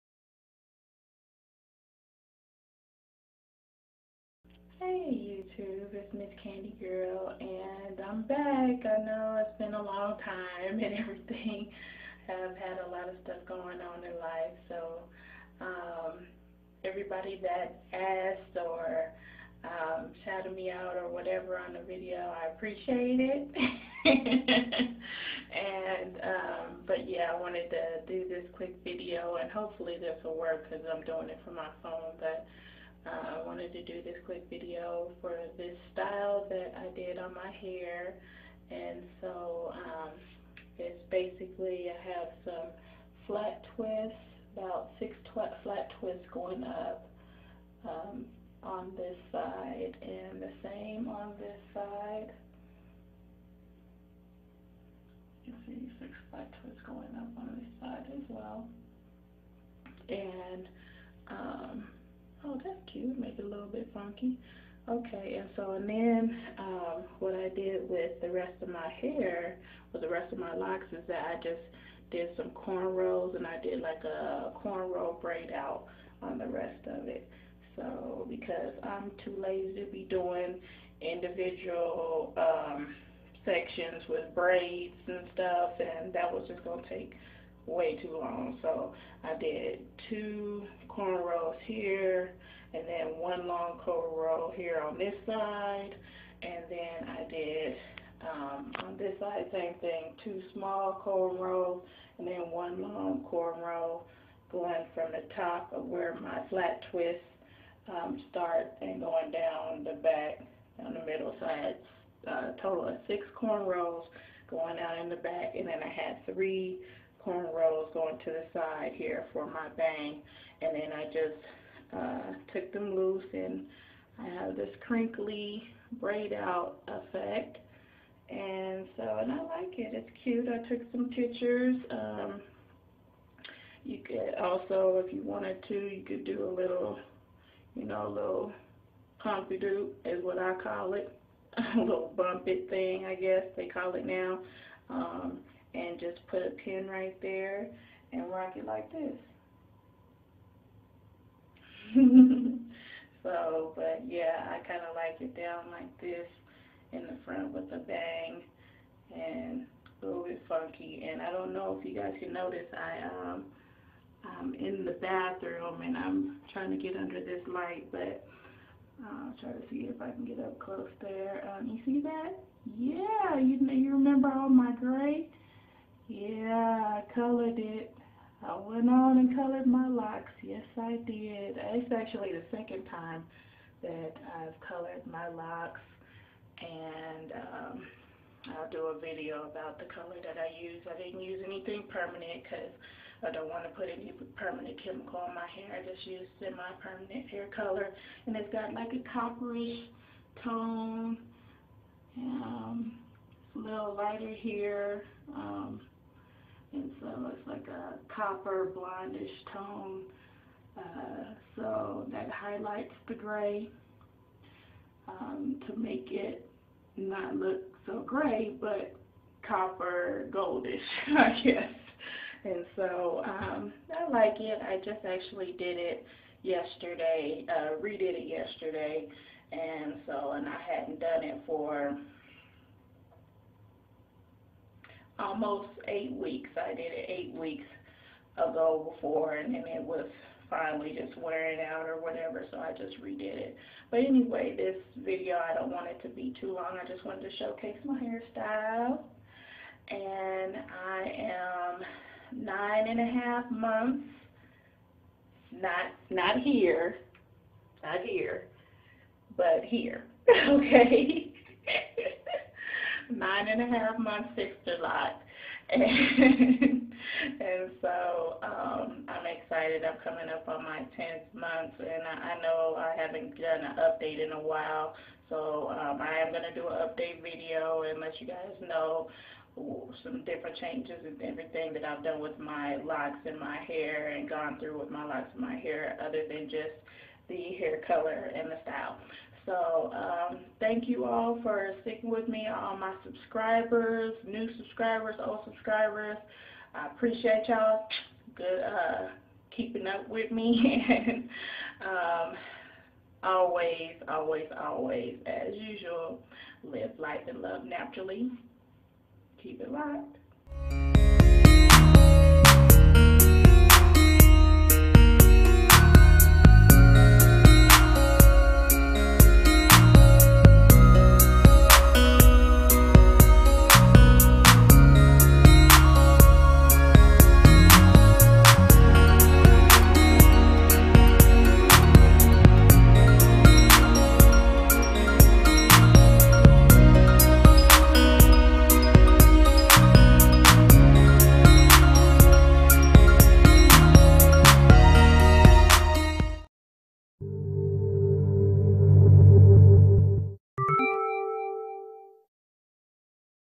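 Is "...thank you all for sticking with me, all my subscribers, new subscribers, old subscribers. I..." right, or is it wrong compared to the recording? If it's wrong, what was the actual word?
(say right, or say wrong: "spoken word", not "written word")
right.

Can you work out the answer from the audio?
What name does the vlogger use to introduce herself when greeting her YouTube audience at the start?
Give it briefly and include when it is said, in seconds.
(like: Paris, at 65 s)
Miss Candy Girl, at 6 s.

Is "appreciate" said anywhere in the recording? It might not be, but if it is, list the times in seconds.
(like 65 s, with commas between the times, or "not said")
22 s, 296 s.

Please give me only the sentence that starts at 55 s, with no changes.
You see six flat twists going up on this side as well.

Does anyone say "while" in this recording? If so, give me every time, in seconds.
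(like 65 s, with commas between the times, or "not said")
274 s.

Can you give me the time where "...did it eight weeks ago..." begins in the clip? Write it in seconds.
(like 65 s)
236 s.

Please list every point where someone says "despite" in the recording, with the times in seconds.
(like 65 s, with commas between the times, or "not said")
not said.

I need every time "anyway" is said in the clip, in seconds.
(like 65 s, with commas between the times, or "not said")
244 s.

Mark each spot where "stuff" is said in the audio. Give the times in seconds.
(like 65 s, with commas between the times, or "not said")
13 s, 85 s.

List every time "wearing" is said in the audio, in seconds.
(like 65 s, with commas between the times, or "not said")
241 s.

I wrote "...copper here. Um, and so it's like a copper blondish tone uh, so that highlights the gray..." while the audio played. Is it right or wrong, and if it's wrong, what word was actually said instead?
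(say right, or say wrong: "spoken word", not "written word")
wrong: "lighter", not "copper".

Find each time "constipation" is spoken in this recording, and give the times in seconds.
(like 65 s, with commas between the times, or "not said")
not said.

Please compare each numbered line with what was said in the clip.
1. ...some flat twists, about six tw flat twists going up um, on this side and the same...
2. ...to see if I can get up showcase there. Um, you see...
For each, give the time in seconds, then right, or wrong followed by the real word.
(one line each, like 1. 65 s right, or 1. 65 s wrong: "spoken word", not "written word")
1. 42 s right
2. 169 s wrong: "close", not "showcase".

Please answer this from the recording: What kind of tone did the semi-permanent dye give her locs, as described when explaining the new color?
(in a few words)
copperish.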